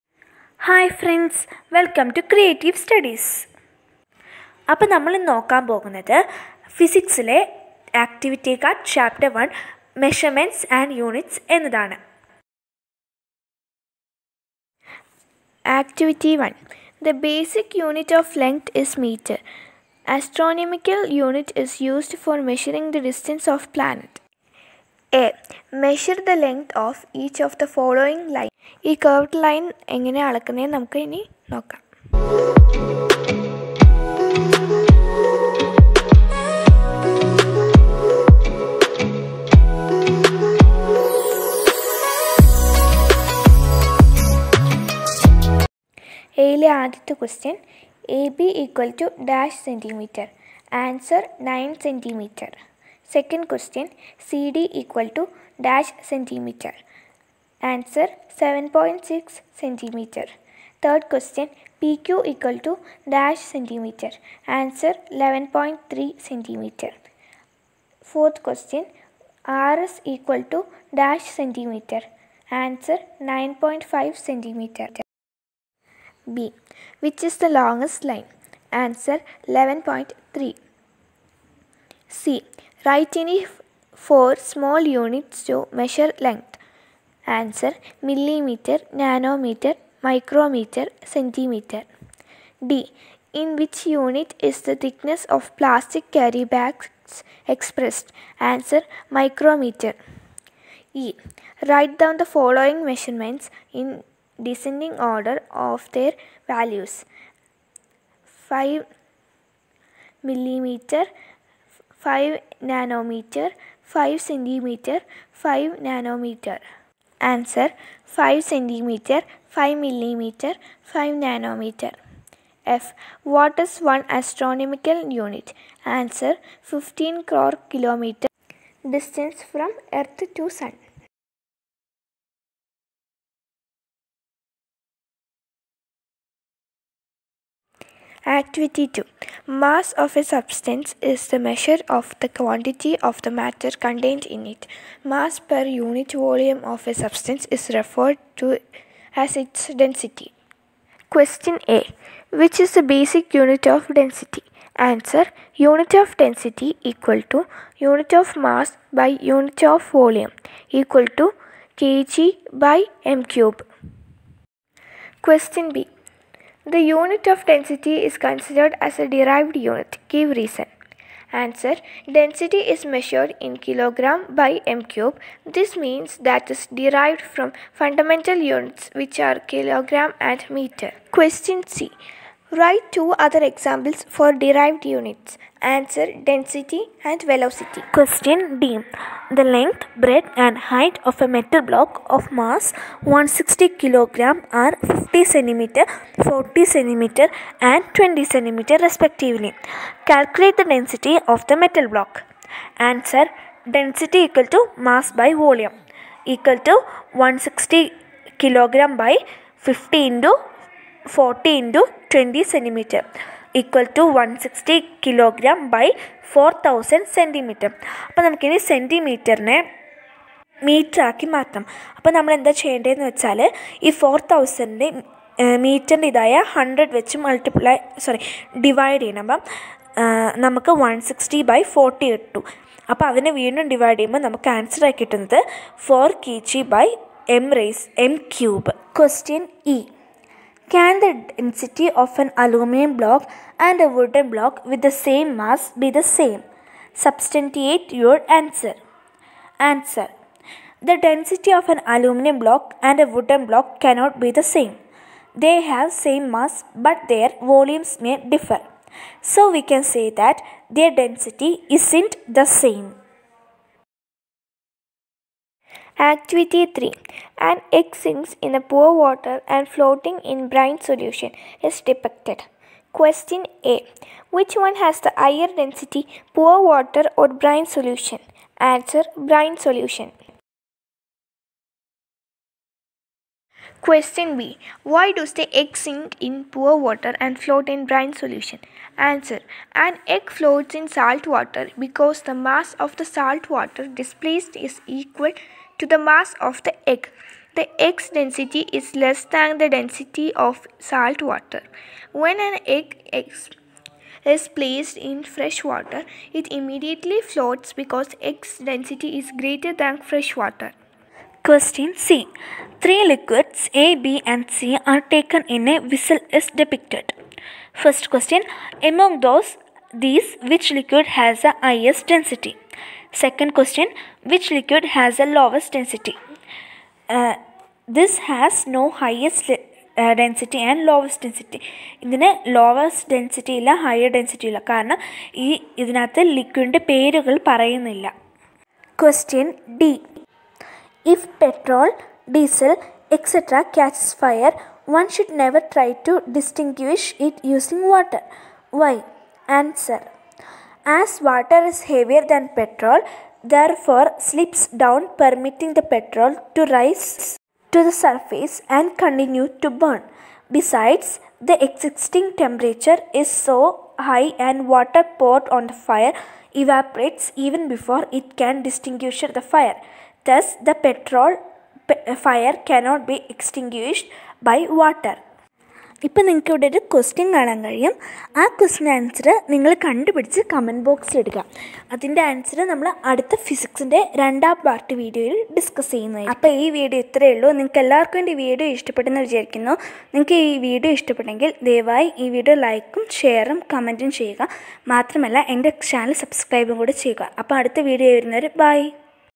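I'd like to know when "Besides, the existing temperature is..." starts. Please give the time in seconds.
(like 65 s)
360 s.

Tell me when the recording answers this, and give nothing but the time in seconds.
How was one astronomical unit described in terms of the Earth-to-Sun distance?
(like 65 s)
126 s.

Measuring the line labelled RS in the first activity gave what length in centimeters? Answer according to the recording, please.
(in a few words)
9.5 centimeter.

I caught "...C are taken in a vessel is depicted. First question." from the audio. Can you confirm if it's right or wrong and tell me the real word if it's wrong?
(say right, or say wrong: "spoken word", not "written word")
right.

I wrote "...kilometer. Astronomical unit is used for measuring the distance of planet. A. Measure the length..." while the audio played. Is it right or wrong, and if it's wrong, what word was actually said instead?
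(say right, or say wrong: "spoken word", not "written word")
wrong: "meter", not "kilometer".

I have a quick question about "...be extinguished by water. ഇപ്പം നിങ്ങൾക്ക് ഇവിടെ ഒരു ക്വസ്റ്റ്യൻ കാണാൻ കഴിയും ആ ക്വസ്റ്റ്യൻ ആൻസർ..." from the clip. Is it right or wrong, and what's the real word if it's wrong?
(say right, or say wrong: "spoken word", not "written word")
right.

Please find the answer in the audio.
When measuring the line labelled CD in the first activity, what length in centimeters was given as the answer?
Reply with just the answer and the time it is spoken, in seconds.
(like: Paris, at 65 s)
7.6 centimeter, at 58 s.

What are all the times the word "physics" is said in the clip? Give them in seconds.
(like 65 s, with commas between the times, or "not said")
6 s.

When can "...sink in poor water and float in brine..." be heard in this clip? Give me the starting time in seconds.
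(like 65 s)
285 s.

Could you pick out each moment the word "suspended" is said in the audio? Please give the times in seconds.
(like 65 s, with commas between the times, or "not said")
not said.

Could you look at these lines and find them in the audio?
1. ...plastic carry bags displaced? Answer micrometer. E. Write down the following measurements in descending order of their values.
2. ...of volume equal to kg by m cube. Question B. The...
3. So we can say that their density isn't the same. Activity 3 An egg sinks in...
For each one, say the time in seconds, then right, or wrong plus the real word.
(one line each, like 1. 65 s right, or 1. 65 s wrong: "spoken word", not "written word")
1. 95 s wrong: "expressed", not "displaced"
2. 159 s right
3. 259 s right.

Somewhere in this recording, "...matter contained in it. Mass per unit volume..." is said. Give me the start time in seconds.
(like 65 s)
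143 s.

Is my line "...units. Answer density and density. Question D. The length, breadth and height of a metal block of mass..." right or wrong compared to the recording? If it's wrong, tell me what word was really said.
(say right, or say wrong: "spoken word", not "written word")
wrong: "velocity", not "density".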